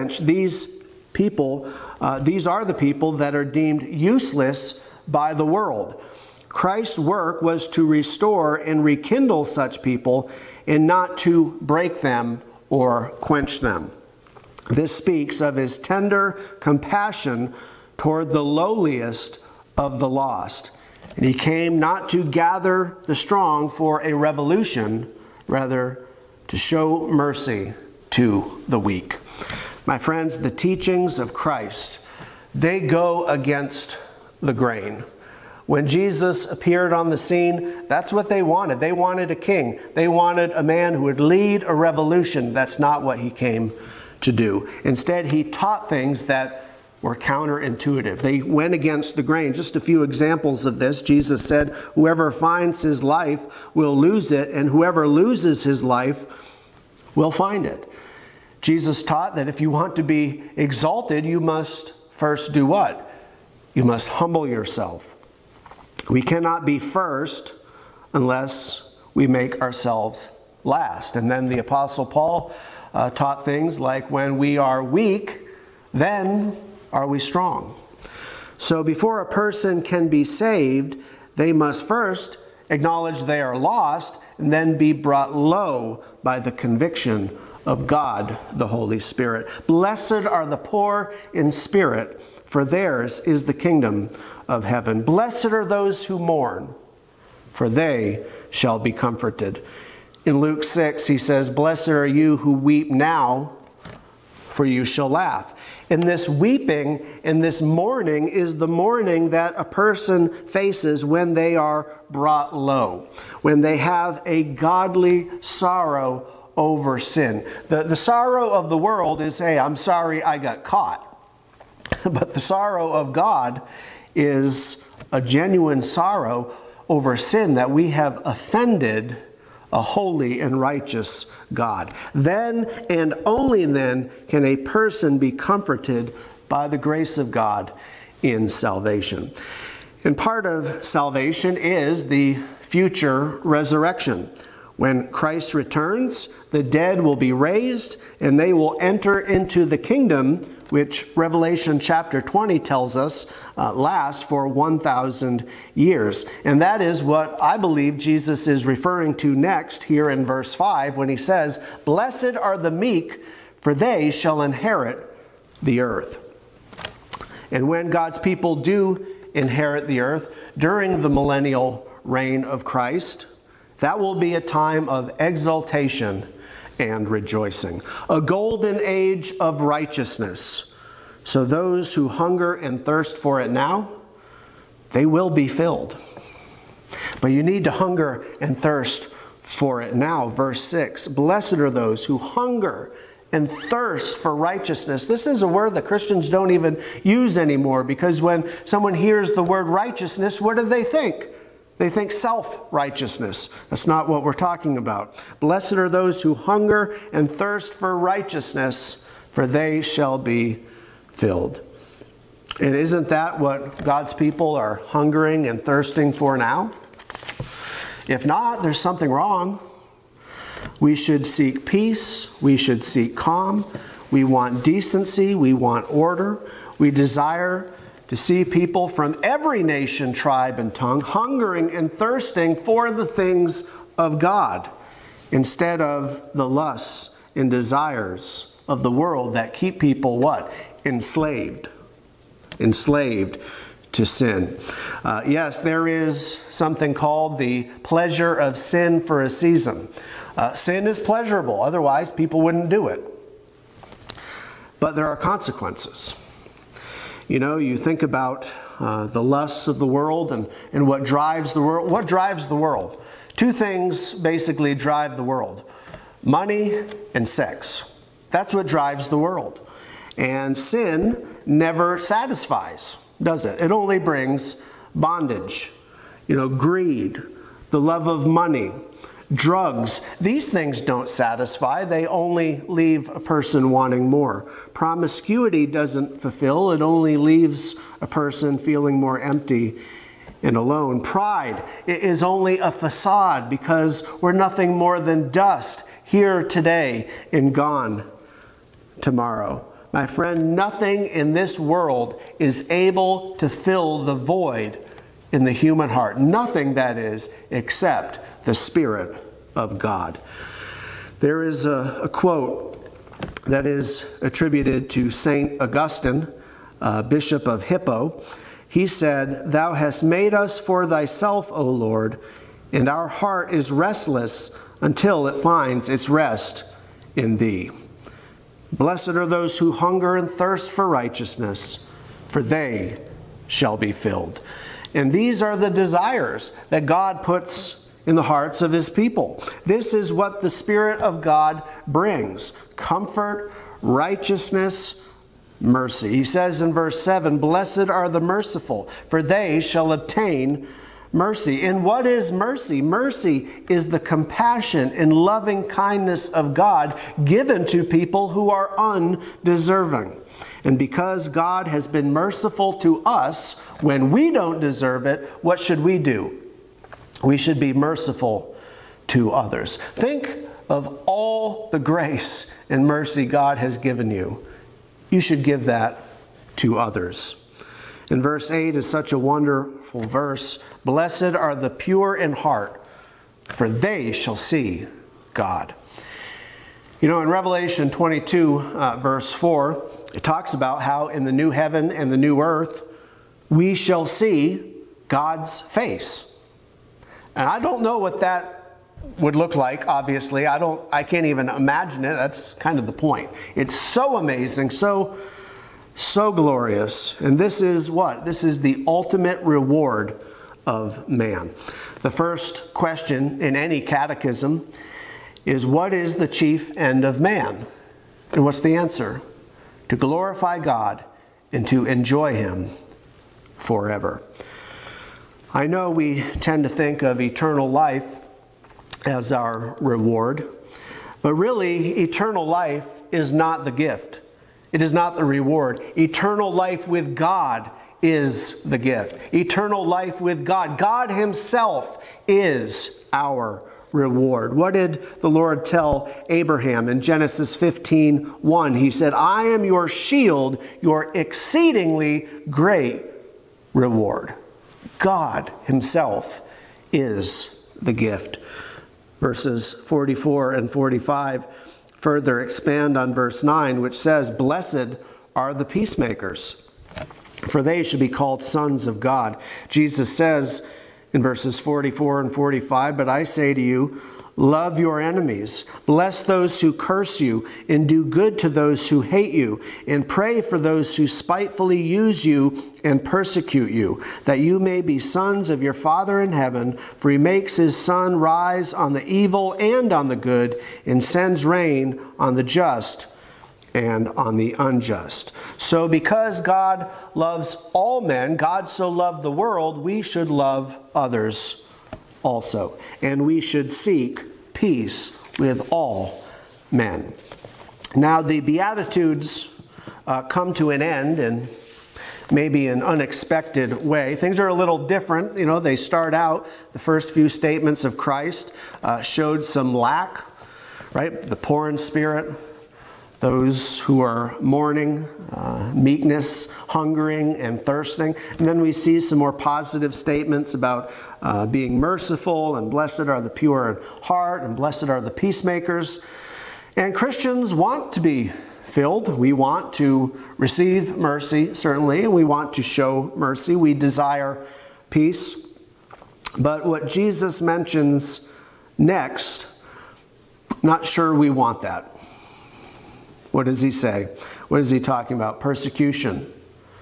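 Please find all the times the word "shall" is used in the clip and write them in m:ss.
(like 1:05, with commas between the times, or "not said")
1:38, 1:44, 2:44, 3:29, 5:33, 5:49, 6:24, 6:33.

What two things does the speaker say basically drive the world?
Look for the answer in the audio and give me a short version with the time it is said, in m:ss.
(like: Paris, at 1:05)
Money and sex, at 4:26.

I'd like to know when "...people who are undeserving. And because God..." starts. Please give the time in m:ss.
5:57.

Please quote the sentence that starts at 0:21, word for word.
And he came not to gather the strong for a revolution, rather to show mercy to the weak.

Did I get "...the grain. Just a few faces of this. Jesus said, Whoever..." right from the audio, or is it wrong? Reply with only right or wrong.
wrong.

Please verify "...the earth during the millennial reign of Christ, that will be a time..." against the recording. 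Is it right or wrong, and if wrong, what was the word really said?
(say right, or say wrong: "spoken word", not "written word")
right.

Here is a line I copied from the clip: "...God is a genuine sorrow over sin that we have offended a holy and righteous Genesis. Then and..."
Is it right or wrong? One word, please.
wrong.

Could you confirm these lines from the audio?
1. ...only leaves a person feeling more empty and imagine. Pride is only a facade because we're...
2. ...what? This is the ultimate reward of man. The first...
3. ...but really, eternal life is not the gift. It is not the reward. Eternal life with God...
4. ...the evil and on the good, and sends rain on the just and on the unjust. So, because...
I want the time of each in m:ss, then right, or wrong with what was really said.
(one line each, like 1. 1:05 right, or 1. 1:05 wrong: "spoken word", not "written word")
1. 4:46 wrong: "alone", not "imagine"
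2. 6:47 right
3. 7:11 right
4. 8:08 right.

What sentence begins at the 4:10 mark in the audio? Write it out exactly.
Uh, sin is pleasurable, otherwise, people wouldn't do it.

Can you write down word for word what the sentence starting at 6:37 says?
And I don't know what that would look like, obviously.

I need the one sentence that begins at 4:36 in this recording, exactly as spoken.
You know, greed, the love of money, drugs.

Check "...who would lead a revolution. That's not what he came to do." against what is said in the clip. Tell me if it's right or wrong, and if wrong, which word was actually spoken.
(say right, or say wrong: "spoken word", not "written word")
right.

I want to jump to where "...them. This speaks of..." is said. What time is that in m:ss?
0:13.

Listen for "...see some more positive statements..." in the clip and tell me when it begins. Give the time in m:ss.
8:48.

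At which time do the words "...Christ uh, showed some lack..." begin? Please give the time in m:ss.
8:37.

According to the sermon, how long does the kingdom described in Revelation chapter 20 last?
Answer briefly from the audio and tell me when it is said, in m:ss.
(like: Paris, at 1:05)
1,000 years, at 2:34.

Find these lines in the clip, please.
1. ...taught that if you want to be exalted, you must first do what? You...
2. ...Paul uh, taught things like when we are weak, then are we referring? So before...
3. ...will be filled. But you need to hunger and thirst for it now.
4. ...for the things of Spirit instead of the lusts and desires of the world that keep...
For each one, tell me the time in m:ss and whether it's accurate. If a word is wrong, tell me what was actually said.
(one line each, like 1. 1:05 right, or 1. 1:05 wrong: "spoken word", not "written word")
1. 0:59 right
2. 1:12 wrong: "strong", not "referring"
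3. 3:05 right
4. 3:52 wrong: "God", not "Spirit".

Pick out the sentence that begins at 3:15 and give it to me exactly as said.
This is a word that Christians don't even use anymore because when someone hears the word righteousness, what do they think?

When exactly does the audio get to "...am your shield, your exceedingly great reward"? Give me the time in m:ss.
7:29.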